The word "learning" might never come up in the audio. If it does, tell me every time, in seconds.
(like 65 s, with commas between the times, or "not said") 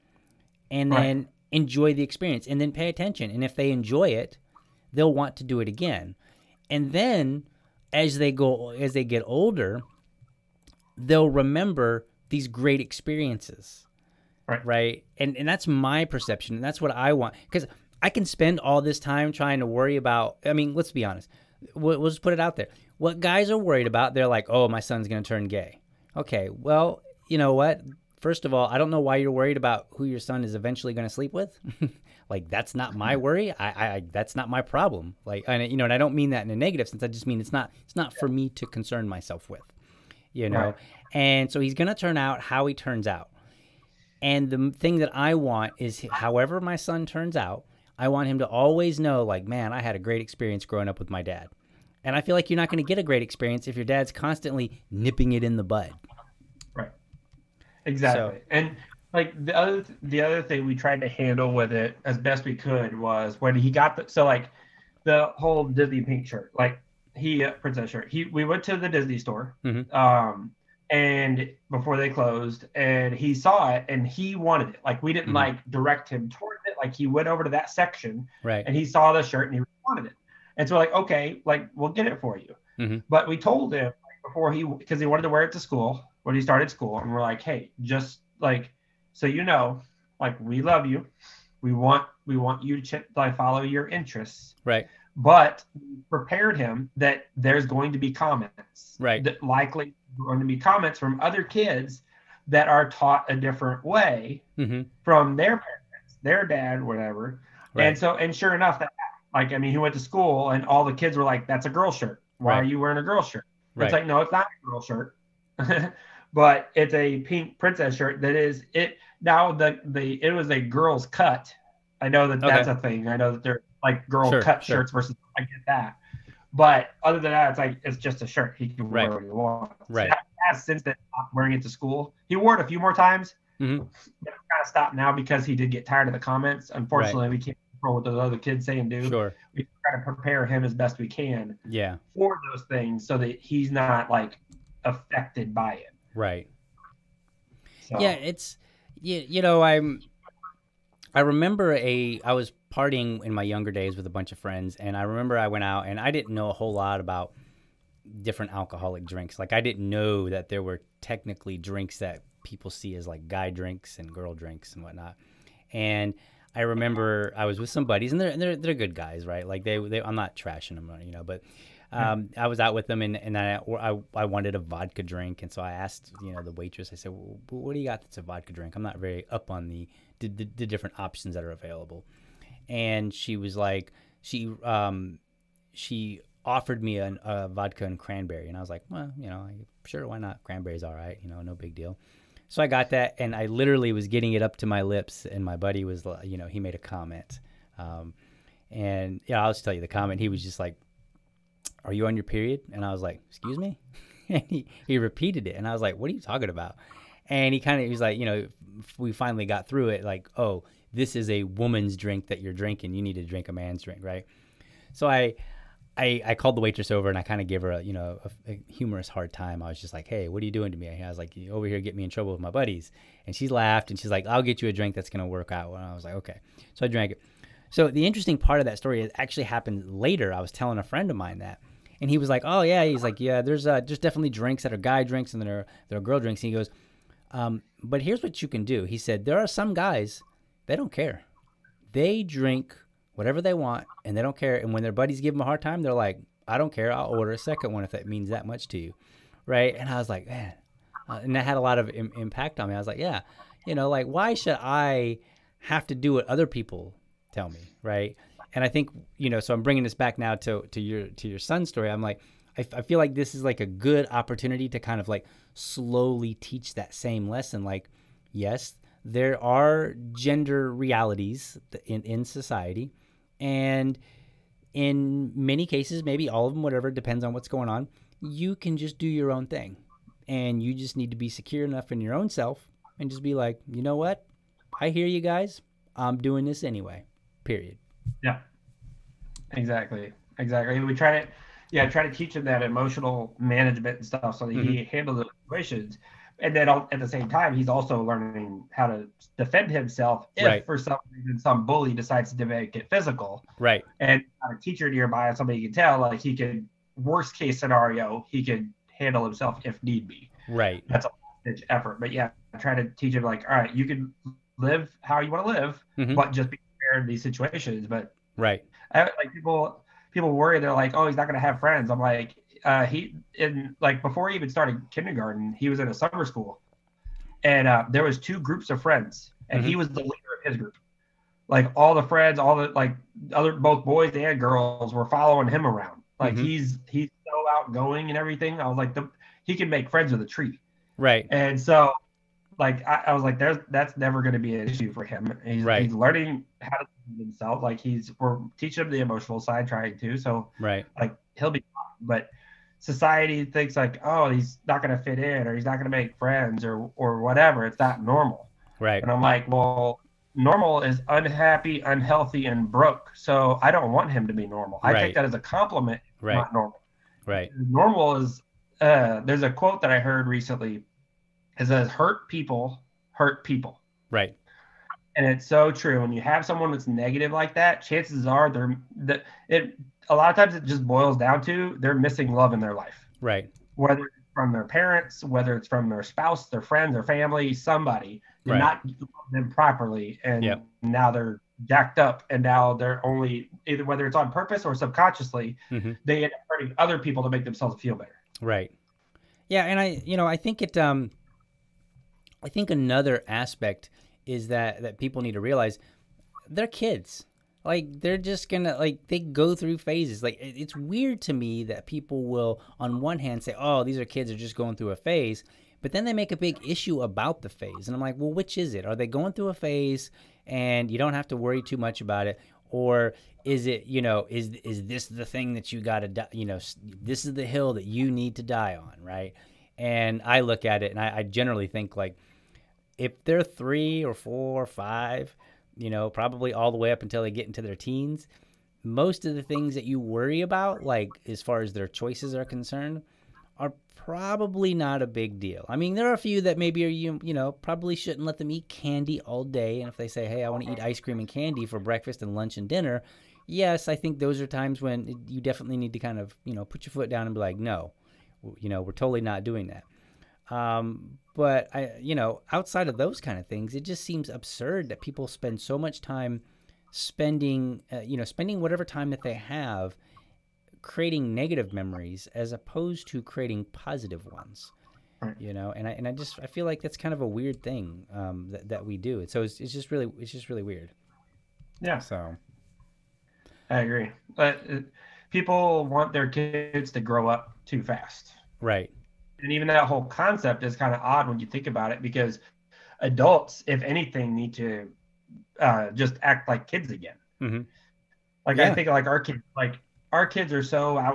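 298 s, 345 s.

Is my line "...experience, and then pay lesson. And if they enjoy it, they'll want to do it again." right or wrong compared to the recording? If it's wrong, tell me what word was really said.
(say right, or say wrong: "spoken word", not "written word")
wrong: "attention", not "lesson".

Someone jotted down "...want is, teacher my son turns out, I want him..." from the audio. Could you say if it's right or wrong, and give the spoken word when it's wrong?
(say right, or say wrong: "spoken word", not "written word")
wrong: "however", not "teacher".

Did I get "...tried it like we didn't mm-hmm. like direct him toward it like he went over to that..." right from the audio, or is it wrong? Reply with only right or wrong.
wrong.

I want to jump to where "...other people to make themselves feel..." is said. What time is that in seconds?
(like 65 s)
396 s.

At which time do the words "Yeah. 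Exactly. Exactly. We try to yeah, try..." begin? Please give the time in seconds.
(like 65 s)
288 s.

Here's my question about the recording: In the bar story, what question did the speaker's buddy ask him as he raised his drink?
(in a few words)
Are you on your period?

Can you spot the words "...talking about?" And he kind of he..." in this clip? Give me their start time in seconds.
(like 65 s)
206 s.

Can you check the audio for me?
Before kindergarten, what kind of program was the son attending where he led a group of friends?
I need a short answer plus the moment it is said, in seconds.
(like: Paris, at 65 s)
summer school, at 325 s.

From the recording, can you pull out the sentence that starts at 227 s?
So the interesting part of that story is actually happened later.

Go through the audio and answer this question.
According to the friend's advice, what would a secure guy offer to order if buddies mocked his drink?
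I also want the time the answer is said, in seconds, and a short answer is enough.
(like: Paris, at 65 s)
a second one, at 247 s.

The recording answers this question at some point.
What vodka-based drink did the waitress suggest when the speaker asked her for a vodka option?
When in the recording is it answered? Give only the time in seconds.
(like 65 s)
187 s.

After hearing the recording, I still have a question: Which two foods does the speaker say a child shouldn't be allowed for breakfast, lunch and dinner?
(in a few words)
ice cream and candy.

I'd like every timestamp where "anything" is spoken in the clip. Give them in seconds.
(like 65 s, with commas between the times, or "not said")
493 s.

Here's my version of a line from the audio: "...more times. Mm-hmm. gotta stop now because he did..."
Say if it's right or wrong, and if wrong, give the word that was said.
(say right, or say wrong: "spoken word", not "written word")
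right.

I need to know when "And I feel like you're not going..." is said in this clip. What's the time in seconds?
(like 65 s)
52 s.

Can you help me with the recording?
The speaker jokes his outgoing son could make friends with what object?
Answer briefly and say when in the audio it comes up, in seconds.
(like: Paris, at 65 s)
a tree, at 340 s.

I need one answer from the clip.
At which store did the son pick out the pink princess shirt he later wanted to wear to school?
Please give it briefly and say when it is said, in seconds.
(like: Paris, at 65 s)
Disney store, at 68 s.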